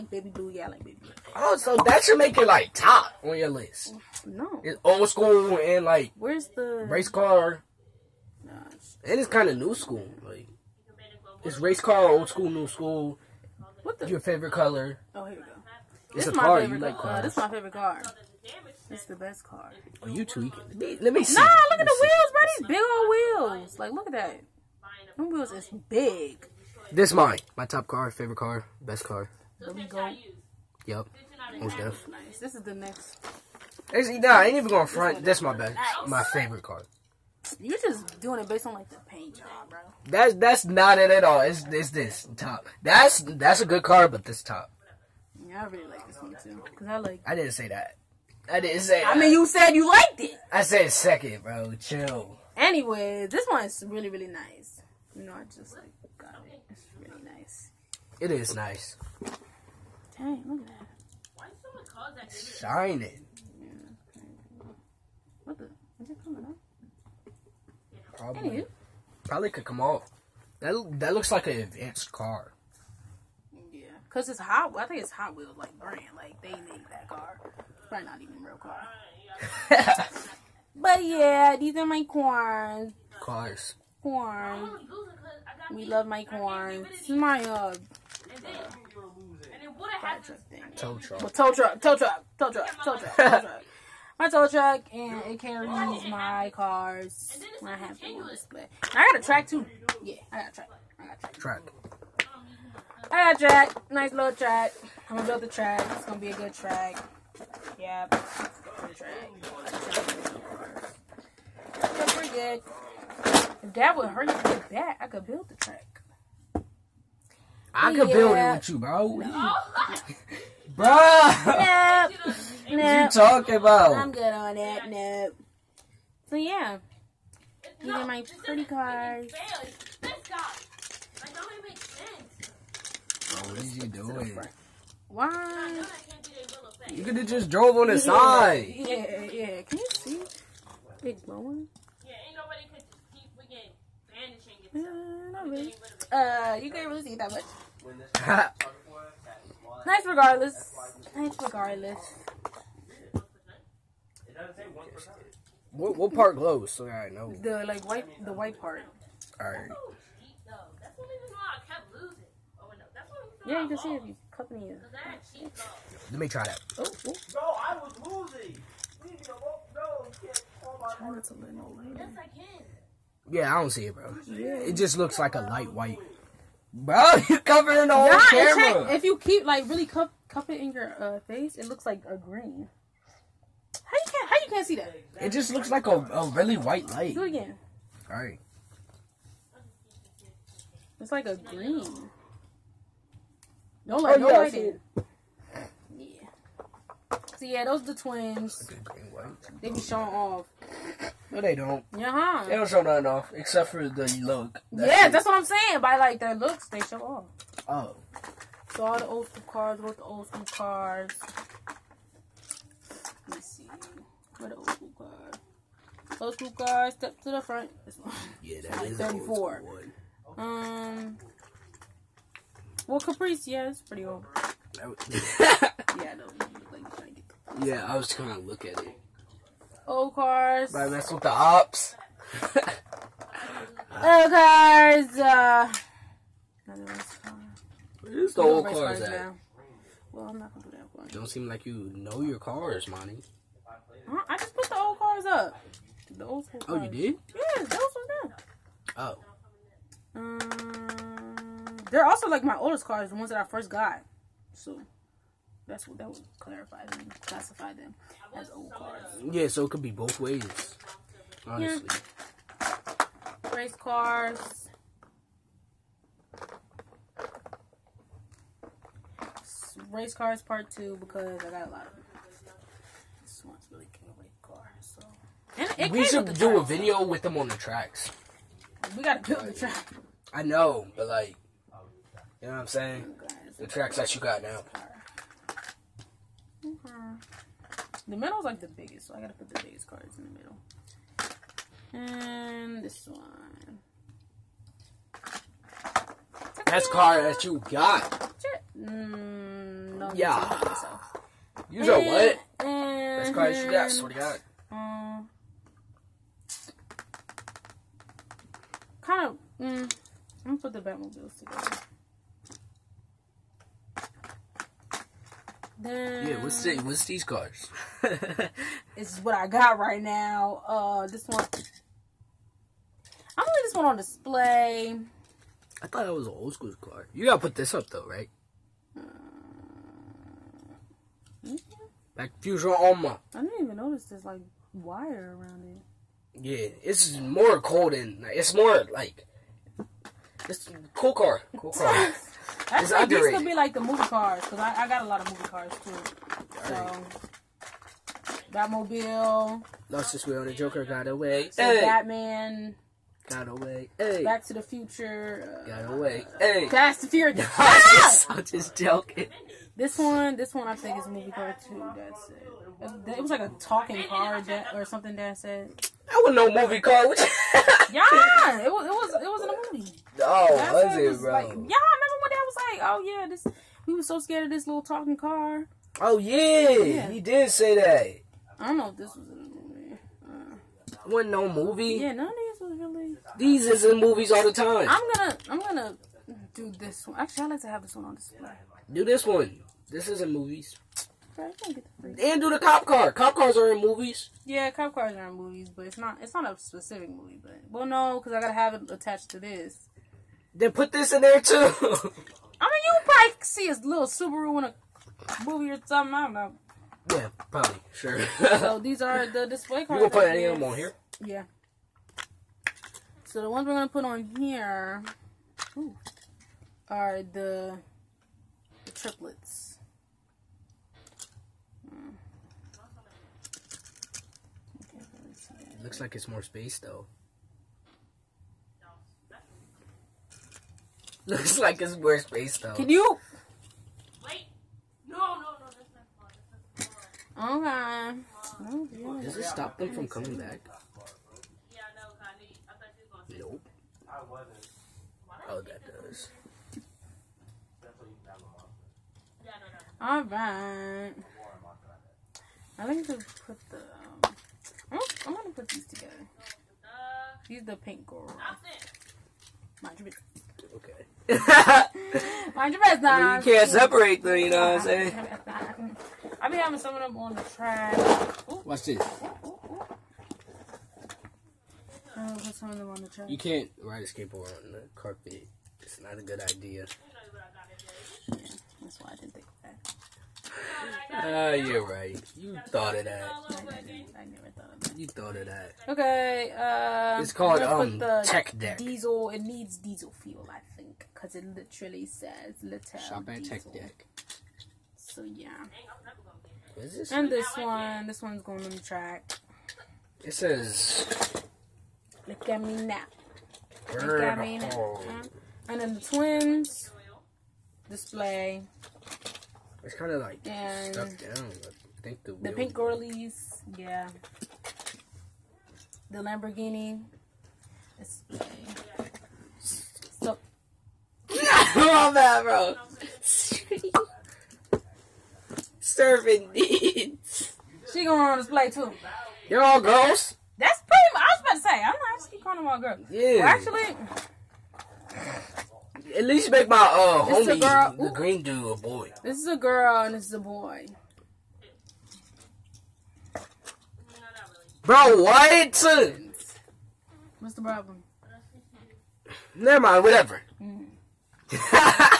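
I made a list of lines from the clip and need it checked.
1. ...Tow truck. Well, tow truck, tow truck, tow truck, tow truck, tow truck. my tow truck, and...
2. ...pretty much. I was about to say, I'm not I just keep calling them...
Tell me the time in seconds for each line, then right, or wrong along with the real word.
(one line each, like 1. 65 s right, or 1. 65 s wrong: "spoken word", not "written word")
1. 90 s right
2. 530 s right.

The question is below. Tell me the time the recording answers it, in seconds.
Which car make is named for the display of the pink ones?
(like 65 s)
516 s.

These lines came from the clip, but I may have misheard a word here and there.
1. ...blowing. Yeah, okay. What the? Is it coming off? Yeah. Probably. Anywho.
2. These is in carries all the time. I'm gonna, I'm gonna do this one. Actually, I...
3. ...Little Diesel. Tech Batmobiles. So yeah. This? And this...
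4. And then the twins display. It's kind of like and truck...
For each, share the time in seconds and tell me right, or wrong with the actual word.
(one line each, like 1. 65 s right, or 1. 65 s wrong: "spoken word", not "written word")
1. 62 s wrong: "shining", not "blowing"
2. 383 s wrong: "movies", not "carries"
3. 492 s wrong: "Deck", not "Batmobiles"
4. 505 s wrong: "stuck", not "truck".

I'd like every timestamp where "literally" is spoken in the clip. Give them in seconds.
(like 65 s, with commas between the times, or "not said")
491 s.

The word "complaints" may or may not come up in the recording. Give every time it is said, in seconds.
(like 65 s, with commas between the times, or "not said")
not said.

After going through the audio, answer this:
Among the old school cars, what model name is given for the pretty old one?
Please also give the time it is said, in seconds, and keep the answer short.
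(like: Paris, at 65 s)
Caprice, at 222 s.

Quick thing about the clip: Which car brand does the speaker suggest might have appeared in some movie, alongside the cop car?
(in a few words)
Subaru.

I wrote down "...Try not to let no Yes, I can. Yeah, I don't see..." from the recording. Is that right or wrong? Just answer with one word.
right.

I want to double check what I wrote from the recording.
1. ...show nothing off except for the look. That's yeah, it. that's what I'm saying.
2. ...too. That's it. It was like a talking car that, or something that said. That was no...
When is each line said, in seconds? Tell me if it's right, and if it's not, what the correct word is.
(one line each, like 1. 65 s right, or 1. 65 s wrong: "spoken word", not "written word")
1. 202 s right
2. 361 s right.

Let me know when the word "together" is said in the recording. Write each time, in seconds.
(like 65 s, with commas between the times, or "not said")
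311 s, 455 s.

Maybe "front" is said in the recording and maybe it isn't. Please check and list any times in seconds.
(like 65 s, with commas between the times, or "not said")
34 s, 217 s.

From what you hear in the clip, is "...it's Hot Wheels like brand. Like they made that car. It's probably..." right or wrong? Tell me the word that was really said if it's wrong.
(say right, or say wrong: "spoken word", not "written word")
right.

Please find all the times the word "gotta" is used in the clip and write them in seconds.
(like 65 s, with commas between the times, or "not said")
279 s, 289 s, 327 s, 398 s.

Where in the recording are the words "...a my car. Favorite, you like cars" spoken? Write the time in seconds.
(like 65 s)
16 s.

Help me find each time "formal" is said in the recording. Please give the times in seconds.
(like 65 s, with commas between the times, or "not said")
not said.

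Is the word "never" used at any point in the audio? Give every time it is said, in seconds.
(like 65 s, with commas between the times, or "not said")
484 s, 549 s.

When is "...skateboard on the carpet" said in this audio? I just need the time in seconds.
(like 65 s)
474 s.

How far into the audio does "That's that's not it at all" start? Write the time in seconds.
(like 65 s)
40 s.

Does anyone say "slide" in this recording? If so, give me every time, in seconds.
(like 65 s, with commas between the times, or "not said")
not said.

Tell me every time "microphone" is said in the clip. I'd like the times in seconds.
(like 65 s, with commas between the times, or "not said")
not said.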